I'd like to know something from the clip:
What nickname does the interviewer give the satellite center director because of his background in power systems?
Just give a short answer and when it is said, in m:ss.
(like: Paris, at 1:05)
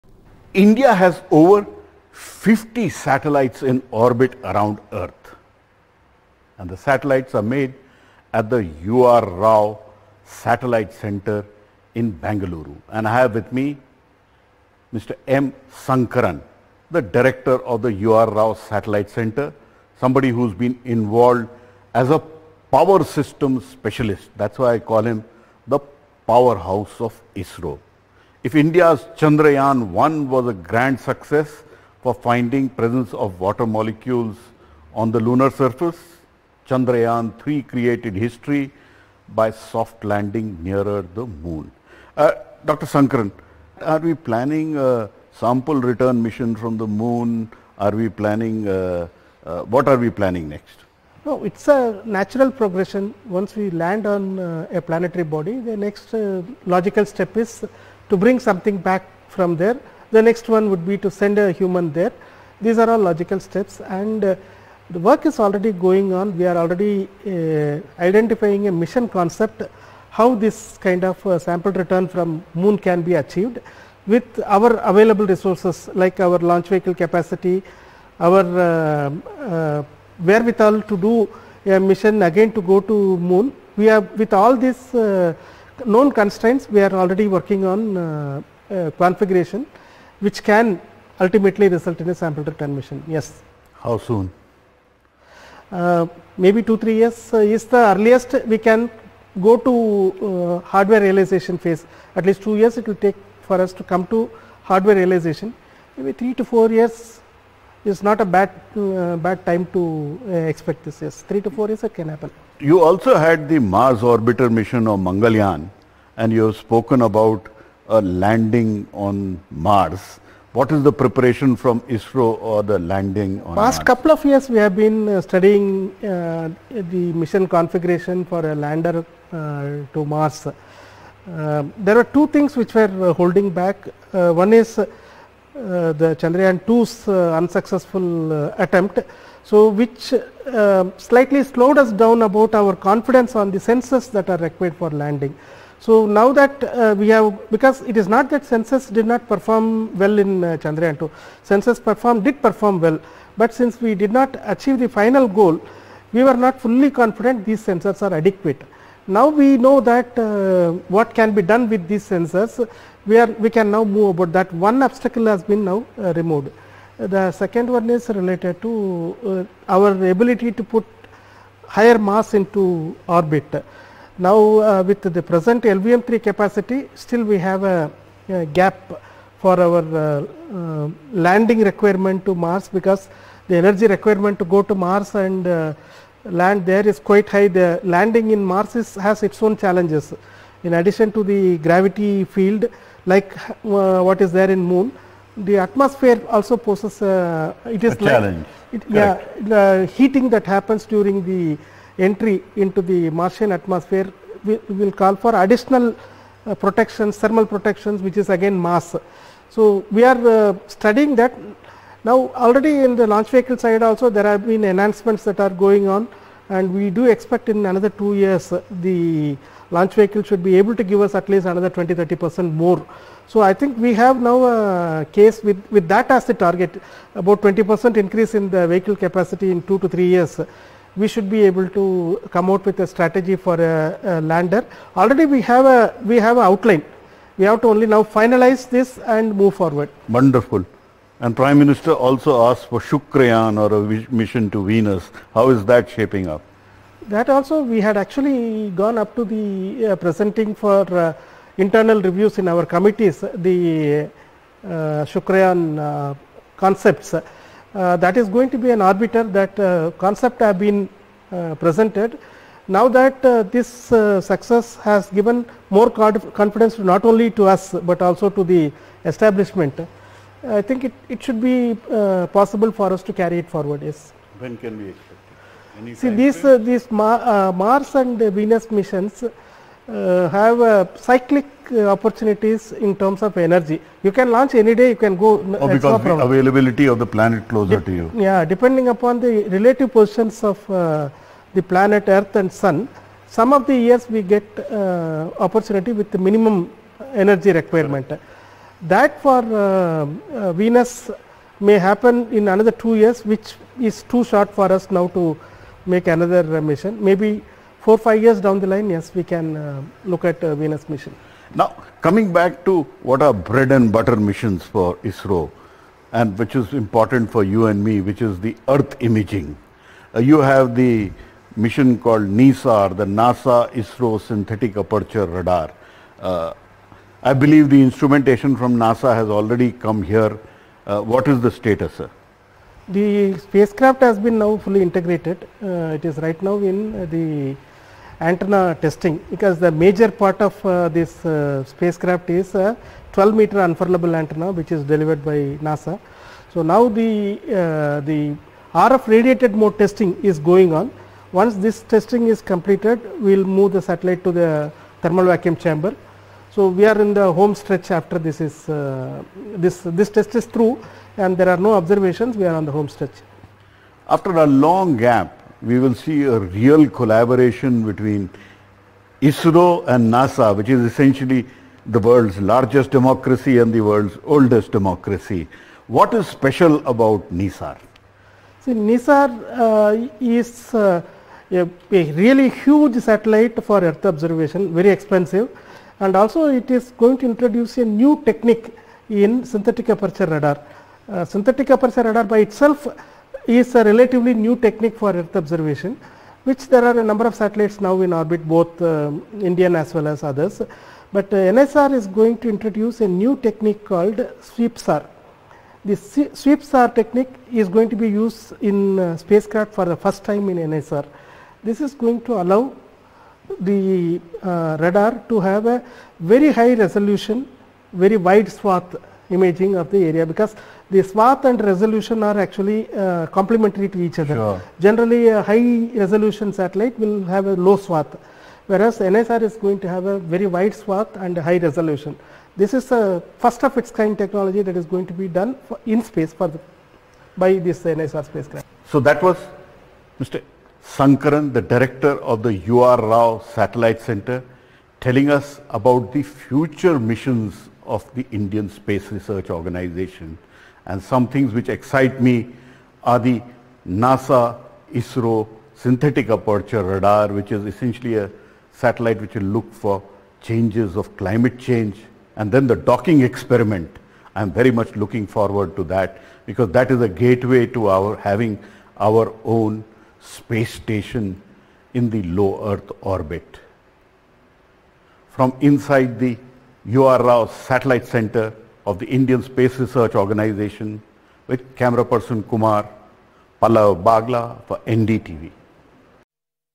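powerhouse of ISRO, at 0:26.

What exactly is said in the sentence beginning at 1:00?
The next one would be to send a human there.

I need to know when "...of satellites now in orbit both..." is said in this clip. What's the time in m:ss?
6:37.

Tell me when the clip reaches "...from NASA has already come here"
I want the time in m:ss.
5:28.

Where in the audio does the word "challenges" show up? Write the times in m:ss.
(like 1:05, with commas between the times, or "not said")
3:09, 3:17.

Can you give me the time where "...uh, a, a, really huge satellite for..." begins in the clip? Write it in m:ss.
6:20.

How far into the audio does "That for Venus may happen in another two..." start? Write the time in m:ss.
4:58.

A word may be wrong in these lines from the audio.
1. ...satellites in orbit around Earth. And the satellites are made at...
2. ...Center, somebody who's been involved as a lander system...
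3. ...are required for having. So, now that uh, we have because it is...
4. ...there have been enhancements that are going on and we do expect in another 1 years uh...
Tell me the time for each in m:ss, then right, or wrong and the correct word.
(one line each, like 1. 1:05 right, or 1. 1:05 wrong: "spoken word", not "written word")
1. 0:02 right
2. 0:19 wrong: "power", not "lander"
3. 2:24 wrong: "landing", not "having"
4. 3:34 wrong: "2", not "1".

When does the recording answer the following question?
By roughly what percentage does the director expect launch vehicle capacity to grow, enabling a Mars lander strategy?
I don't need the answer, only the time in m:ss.
3:47.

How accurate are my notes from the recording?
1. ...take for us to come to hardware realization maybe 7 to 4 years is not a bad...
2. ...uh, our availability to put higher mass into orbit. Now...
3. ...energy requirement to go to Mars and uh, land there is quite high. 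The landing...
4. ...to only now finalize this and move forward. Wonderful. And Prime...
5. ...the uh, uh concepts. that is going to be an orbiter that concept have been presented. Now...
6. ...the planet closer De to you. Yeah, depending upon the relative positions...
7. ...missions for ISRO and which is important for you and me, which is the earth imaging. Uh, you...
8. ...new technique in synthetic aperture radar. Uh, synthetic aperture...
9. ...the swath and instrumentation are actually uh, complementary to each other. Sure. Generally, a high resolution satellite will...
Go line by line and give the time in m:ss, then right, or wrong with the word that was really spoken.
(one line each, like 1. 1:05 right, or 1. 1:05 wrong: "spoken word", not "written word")
1. 1:43 wrong: "3", not "7"
2. 2:49 wrong: "ability", not "availability"
3. 3:03 right
4. 3:57 right
5. 4:13 right
6. 4:46 right
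7. 5:14 right
8. 6:27 right
9. 7:00 wrong: "resolution", not "instrumentation".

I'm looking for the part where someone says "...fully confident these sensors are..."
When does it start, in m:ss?
2:36.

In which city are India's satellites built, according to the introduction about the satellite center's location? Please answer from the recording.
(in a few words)
Bangalore.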